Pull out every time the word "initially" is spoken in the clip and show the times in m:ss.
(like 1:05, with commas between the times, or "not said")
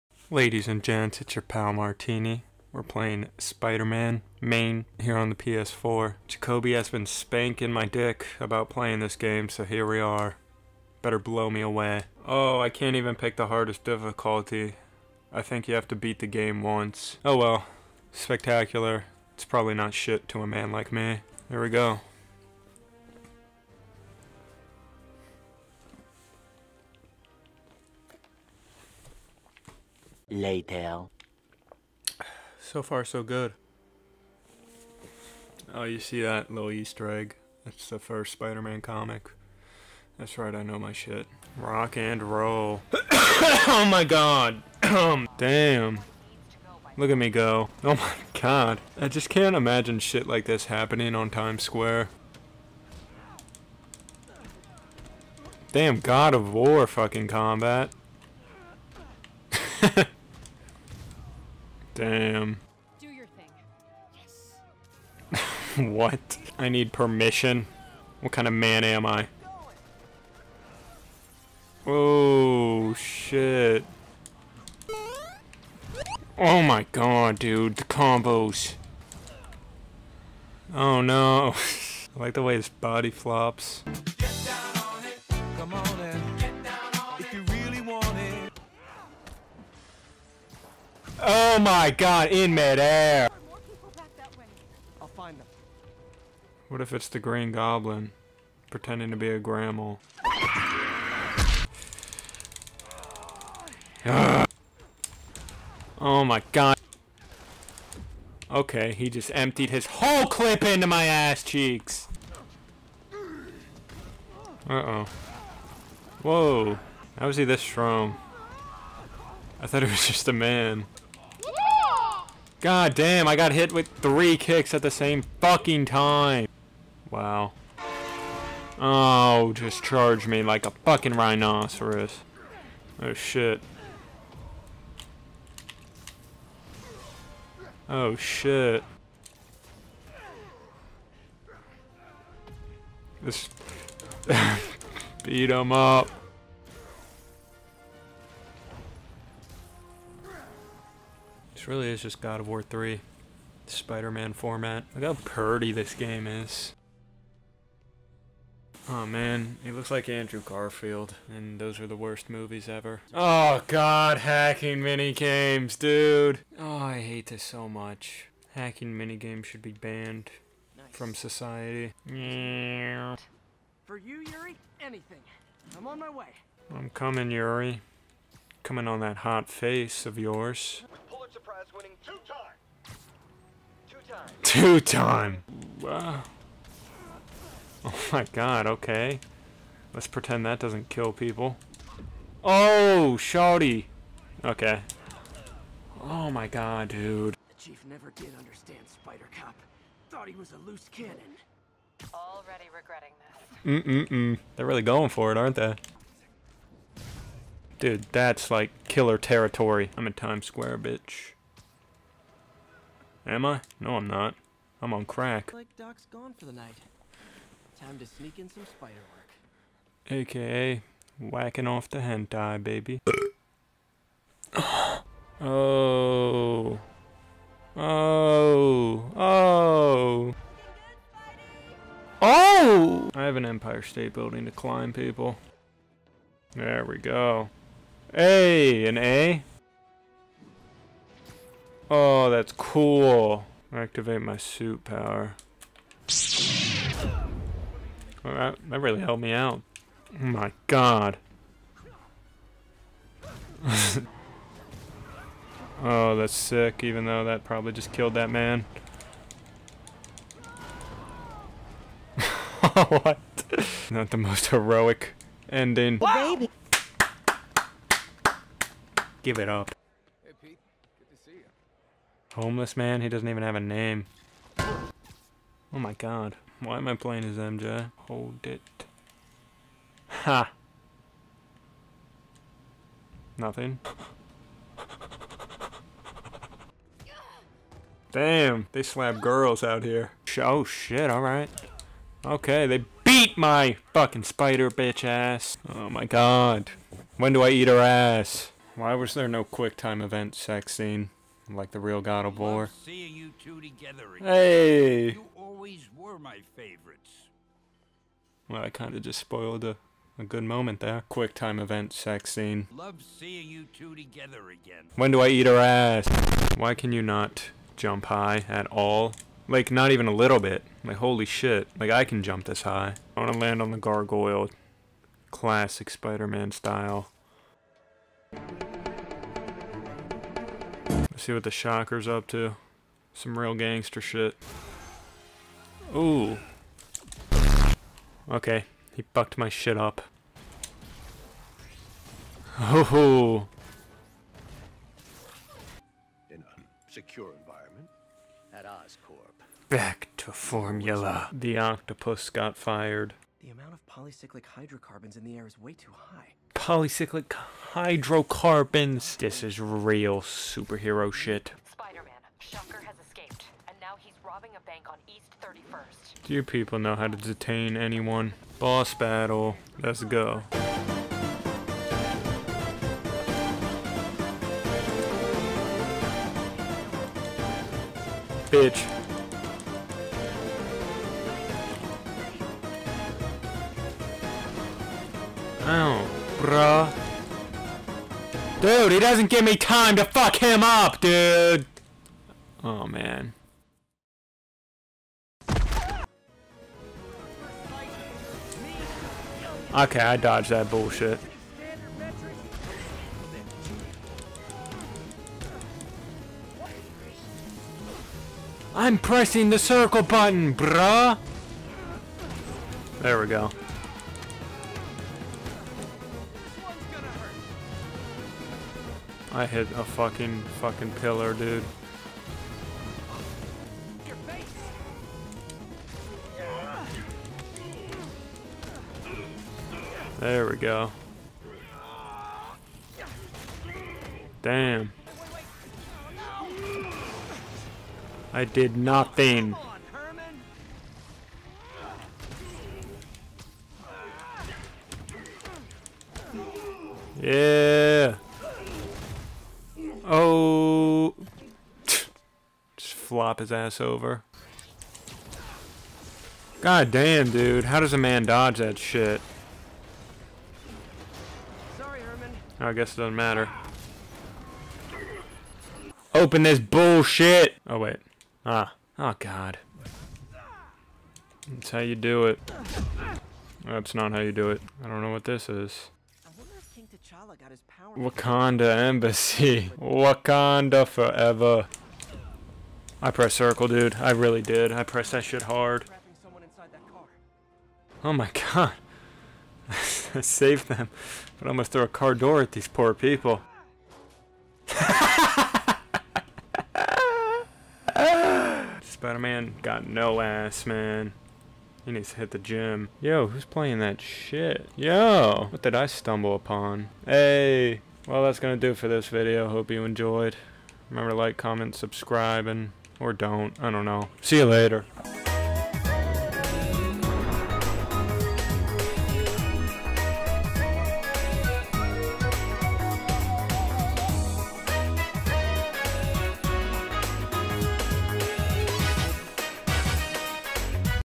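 not said.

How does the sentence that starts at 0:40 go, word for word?
That's right, I know my shit.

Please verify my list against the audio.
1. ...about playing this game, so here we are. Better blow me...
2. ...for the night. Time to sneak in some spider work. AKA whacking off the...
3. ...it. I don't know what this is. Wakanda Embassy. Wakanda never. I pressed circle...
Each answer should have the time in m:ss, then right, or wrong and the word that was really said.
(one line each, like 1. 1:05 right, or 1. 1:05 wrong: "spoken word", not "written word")
1. 0:08 right
2. 3:36 right
3. 7:54 wrong: "forever", not "never".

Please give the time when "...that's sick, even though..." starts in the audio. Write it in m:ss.
4:16.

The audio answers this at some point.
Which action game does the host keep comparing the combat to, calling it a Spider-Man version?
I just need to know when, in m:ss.
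2:32.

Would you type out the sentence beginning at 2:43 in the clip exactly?
Oh god, hacking mini games, dude!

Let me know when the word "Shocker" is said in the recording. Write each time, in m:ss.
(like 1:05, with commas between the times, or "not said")
5:31, 6:02.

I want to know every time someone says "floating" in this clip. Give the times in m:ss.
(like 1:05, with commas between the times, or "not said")
not said.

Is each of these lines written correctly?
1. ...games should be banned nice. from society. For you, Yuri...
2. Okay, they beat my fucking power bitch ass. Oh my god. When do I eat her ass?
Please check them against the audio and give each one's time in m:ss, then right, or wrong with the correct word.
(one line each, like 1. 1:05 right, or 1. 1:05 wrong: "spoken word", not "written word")
1. 2:49 right
2. 4:52 wrong: "spider", not "power".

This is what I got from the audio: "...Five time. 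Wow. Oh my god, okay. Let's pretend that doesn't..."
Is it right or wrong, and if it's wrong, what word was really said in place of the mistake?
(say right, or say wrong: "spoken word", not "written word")
wrong: "Two", not "Five".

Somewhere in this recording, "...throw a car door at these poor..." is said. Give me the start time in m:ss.
8:11.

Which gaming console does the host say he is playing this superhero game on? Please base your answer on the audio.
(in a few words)
PS4.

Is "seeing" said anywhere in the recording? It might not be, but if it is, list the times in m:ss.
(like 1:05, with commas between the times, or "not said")
5:02, 5:13.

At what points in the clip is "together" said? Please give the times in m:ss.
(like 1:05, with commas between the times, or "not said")
5:03, 5:13.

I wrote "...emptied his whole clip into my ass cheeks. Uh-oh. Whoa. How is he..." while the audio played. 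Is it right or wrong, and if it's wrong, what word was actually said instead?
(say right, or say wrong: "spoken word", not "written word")
right.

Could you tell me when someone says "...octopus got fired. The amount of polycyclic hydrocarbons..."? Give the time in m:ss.
5:51.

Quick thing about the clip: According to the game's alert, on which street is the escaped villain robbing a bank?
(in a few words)
East 31st.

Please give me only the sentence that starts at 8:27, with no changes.
Hey, well, that's gonna do for this video.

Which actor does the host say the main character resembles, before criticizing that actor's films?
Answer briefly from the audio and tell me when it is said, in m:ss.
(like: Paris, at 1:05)
Andrew Garfield, at 2:40.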